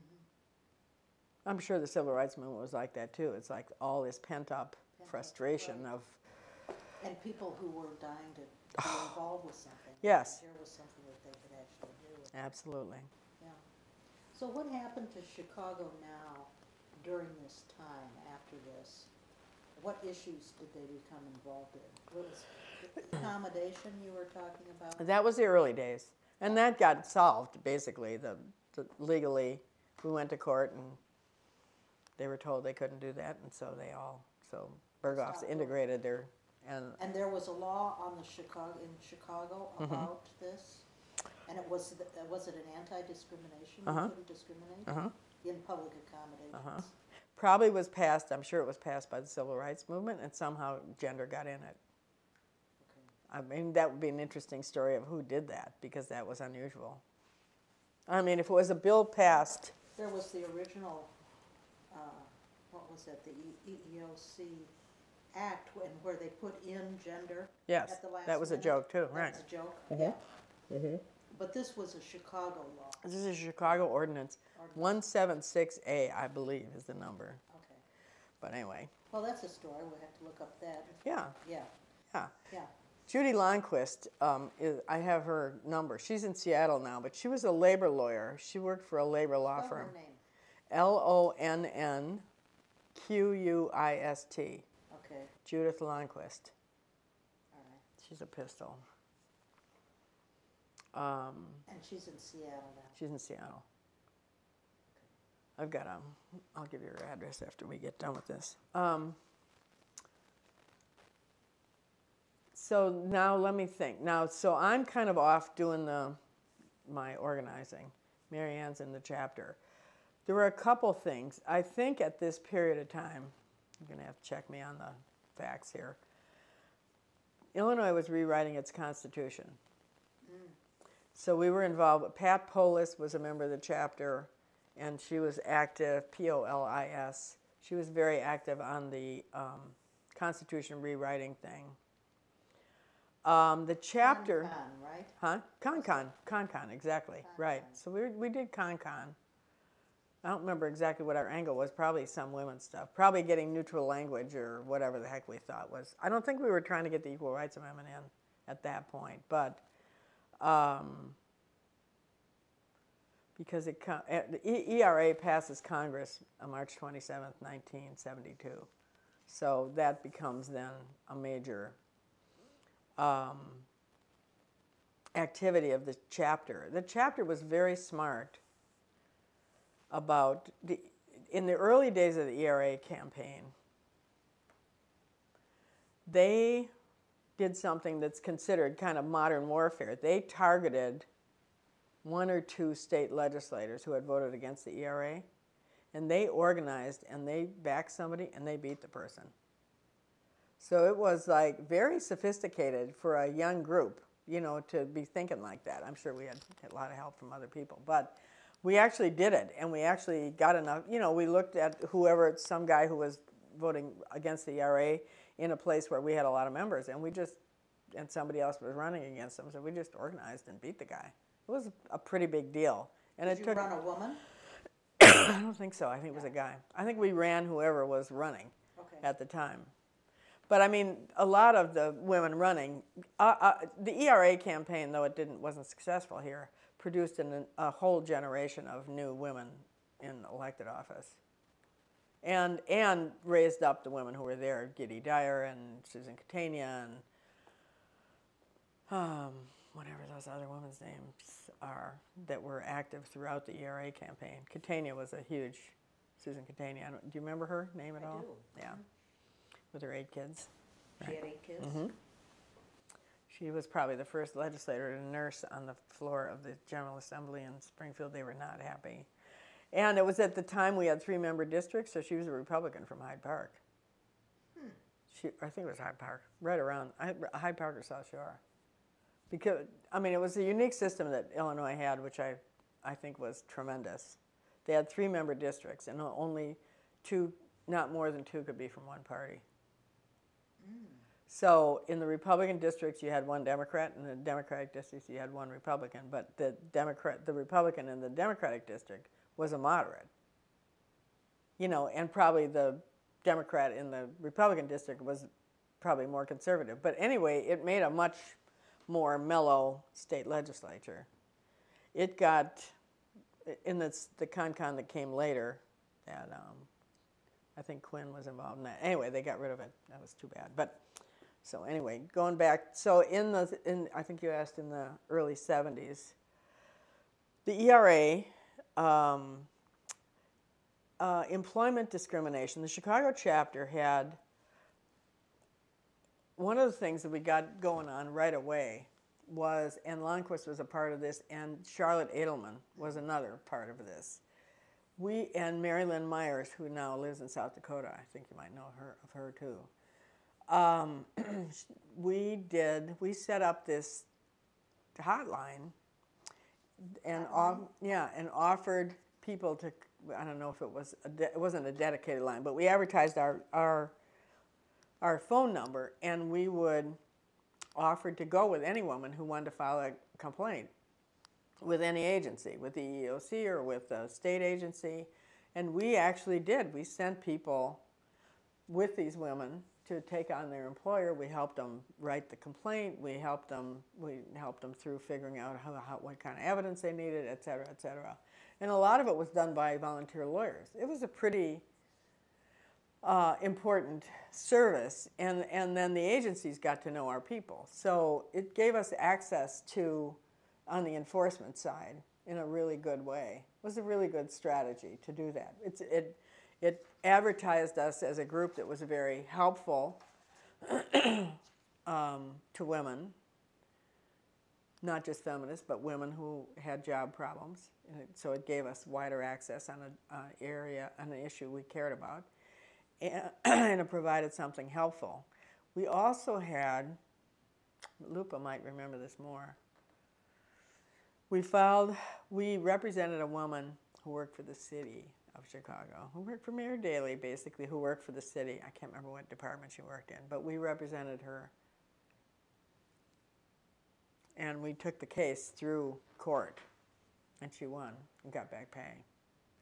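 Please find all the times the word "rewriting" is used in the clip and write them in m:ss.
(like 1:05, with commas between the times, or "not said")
2:08, 2:20.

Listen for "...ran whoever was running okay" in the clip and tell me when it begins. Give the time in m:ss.
3:47.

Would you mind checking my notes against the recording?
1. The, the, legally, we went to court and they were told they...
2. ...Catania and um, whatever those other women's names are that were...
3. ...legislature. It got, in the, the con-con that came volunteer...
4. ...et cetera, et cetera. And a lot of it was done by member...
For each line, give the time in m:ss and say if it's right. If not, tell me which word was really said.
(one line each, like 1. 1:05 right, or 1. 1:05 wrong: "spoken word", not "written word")
1. 0:28 right
2. 4:06 right
3. 5:10 wrong: "later", not "volunteer"
4. 6:27 wrong: "volunteer", not "member".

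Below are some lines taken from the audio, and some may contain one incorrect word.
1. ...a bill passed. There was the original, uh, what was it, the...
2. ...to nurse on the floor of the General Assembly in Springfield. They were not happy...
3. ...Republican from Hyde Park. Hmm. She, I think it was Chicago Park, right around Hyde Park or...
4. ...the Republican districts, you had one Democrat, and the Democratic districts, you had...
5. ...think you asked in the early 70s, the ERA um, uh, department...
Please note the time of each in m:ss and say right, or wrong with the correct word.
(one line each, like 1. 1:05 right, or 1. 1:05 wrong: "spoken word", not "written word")
1. 0:58 right
2. 4:24 right
3. 4:32 wrong: "Hyde", not "Chicago"
4. 4:52 right
5. 5:24 wrong: "employment", not "department".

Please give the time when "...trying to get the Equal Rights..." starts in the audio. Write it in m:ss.
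2:36.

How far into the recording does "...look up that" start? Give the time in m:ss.
1:20.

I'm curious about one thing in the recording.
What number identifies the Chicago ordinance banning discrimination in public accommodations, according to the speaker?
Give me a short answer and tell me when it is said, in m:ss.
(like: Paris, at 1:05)
176A, at 1:15.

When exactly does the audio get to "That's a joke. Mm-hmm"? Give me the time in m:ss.
1:09.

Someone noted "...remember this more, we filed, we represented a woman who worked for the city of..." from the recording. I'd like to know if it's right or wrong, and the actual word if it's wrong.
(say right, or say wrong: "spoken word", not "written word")
right.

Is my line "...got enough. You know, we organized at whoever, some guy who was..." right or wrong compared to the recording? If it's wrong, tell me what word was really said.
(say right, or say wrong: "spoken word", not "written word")
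wrong: "looked", not "organized".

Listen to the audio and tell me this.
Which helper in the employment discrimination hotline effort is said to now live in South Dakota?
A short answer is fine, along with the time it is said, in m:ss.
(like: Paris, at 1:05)
Mary Lynn Myers, at 5:45.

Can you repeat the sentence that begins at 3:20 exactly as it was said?
So it was like very sophisticated for a young group, you know, to be thinking like that.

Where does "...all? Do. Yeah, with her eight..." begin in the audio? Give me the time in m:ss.
4:18.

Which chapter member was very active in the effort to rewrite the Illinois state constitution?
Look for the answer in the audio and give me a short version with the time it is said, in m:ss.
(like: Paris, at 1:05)
Pat Polis, at 2:12.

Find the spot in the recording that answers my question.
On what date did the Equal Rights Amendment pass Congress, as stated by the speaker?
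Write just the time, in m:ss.
2:46.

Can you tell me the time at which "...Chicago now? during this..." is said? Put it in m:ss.
0:15.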